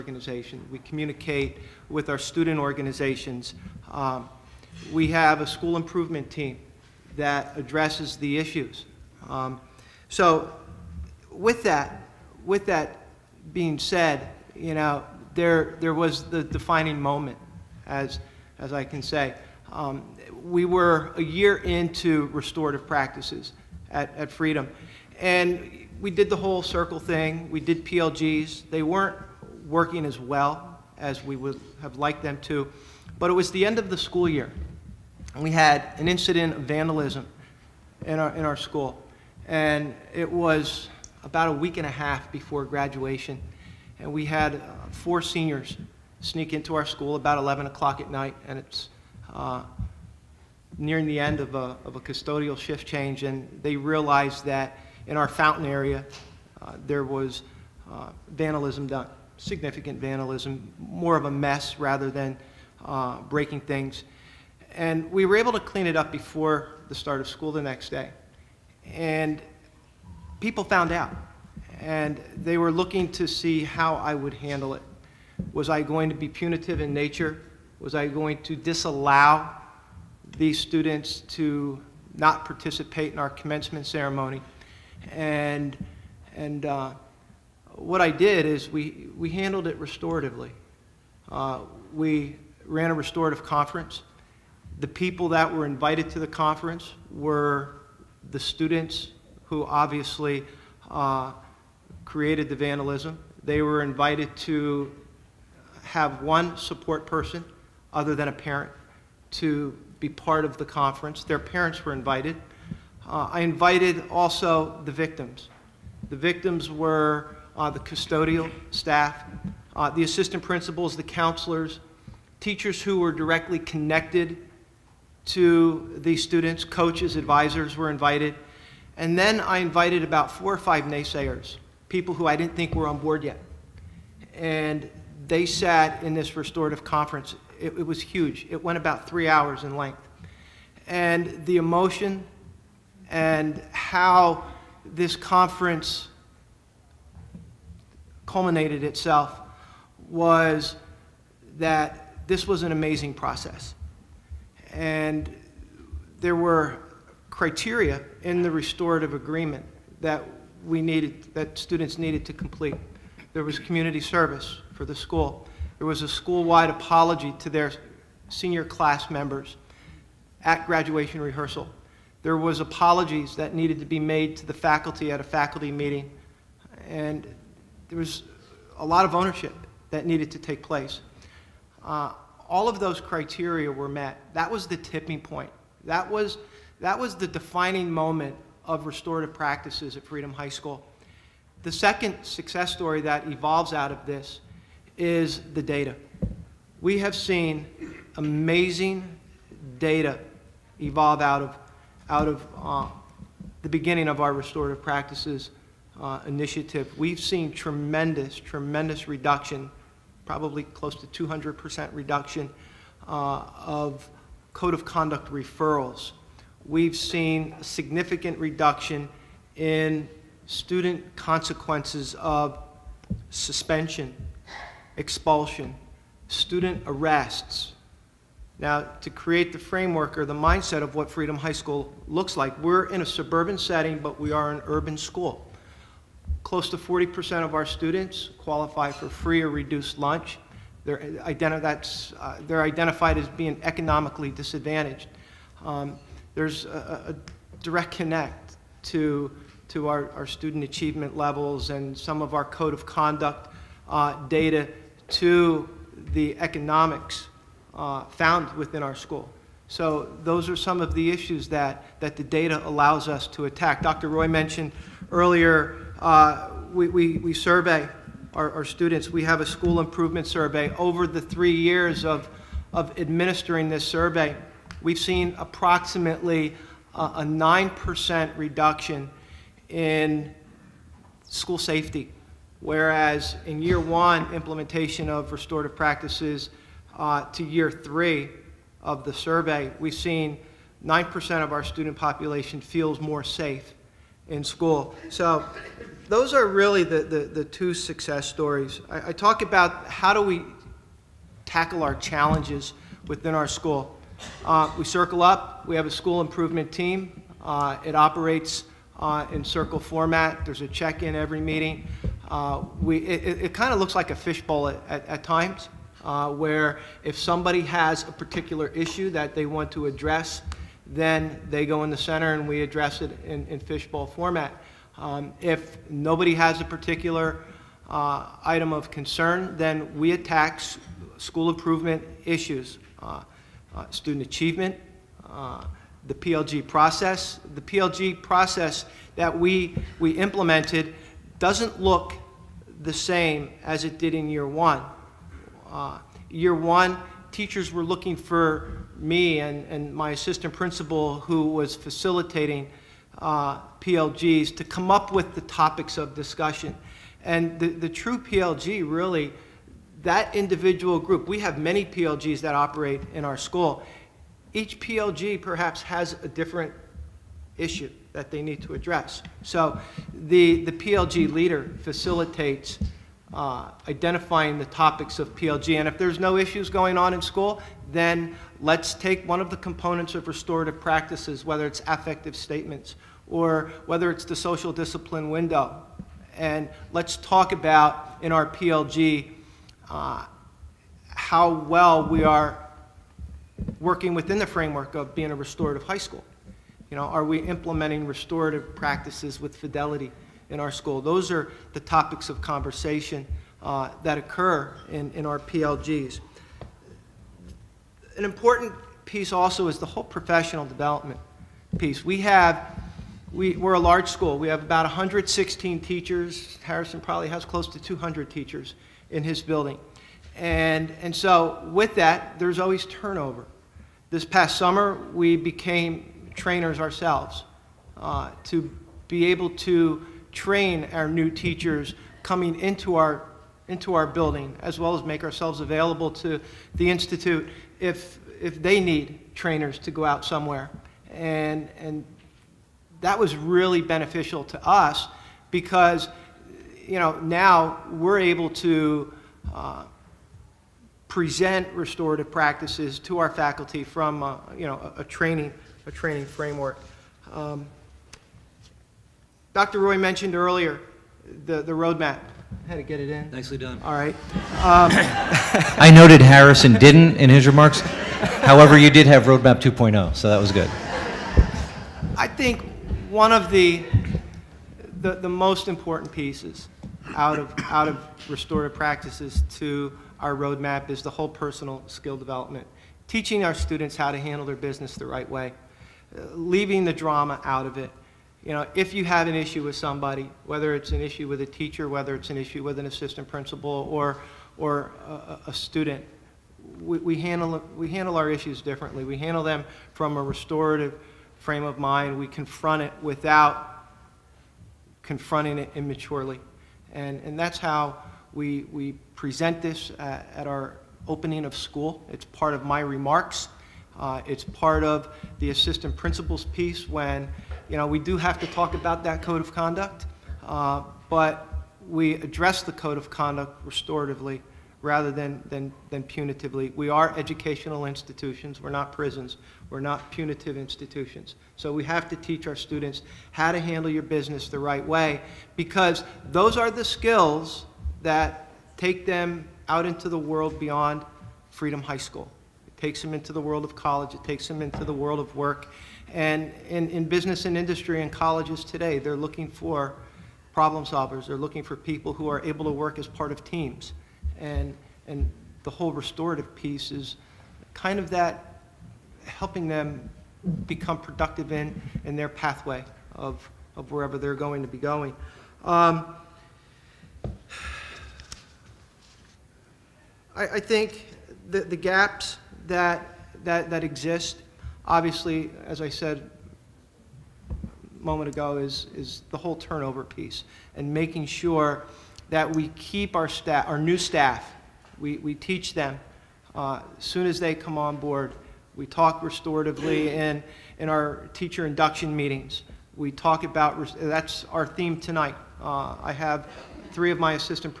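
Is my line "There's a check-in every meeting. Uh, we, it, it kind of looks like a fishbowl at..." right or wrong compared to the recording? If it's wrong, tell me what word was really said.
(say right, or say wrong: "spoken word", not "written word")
right.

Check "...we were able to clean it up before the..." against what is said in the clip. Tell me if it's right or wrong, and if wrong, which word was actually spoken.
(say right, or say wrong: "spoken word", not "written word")
right.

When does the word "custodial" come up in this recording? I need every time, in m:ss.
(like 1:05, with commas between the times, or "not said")
0:51, 1:57.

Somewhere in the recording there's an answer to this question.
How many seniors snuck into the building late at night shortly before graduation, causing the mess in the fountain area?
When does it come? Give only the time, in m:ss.
0:44.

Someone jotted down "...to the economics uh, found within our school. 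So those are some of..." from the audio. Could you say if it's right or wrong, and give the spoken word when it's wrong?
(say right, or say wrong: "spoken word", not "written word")
right.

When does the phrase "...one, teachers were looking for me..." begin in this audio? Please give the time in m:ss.
5:46.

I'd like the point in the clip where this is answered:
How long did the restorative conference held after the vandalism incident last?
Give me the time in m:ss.
2:19.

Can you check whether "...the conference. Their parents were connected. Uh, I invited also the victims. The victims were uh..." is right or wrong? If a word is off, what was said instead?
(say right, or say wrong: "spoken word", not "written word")
wrong: "invited", not "connected".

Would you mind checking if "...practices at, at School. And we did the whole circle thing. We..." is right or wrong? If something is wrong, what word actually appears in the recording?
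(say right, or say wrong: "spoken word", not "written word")
wrong: "Freedom", not "School".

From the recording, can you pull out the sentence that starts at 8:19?
We handle them from a restorative frame of mind.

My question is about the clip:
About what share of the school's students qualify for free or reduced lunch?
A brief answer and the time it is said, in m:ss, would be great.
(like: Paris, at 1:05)
40%, at 3:56.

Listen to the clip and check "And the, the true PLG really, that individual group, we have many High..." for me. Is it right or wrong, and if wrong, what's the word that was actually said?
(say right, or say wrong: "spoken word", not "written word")
wrong: "PLGs", not "High".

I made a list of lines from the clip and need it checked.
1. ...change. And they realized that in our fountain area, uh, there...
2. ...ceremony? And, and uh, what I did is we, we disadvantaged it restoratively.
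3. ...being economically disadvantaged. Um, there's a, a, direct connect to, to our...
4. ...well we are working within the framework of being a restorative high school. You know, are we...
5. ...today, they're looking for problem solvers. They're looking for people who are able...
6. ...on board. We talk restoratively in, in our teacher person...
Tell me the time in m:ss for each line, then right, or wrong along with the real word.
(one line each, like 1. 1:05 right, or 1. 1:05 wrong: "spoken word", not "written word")
1. 0:52 right
2. 1:23 wrong: "handled", not "disadvantaged"
3. 4:03 right
4. 6:31 right
5. 9:08 right
6. 9:47 wrong: "induction", not "person".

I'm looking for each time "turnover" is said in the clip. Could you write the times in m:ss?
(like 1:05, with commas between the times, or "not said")
7:02, 9:39.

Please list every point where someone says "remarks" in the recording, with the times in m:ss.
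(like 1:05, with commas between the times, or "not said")
7:47, 8:32.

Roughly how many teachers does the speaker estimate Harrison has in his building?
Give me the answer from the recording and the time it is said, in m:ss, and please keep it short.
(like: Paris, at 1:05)
200, at 6:57.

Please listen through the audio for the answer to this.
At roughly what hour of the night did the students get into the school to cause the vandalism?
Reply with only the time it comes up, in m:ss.
0:47.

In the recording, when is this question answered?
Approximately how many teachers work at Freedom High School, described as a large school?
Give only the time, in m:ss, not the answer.
6:54.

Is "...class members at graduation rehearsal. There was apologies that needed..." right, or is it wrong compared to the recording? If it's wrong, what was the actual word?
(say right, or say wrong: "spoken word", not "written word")
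right.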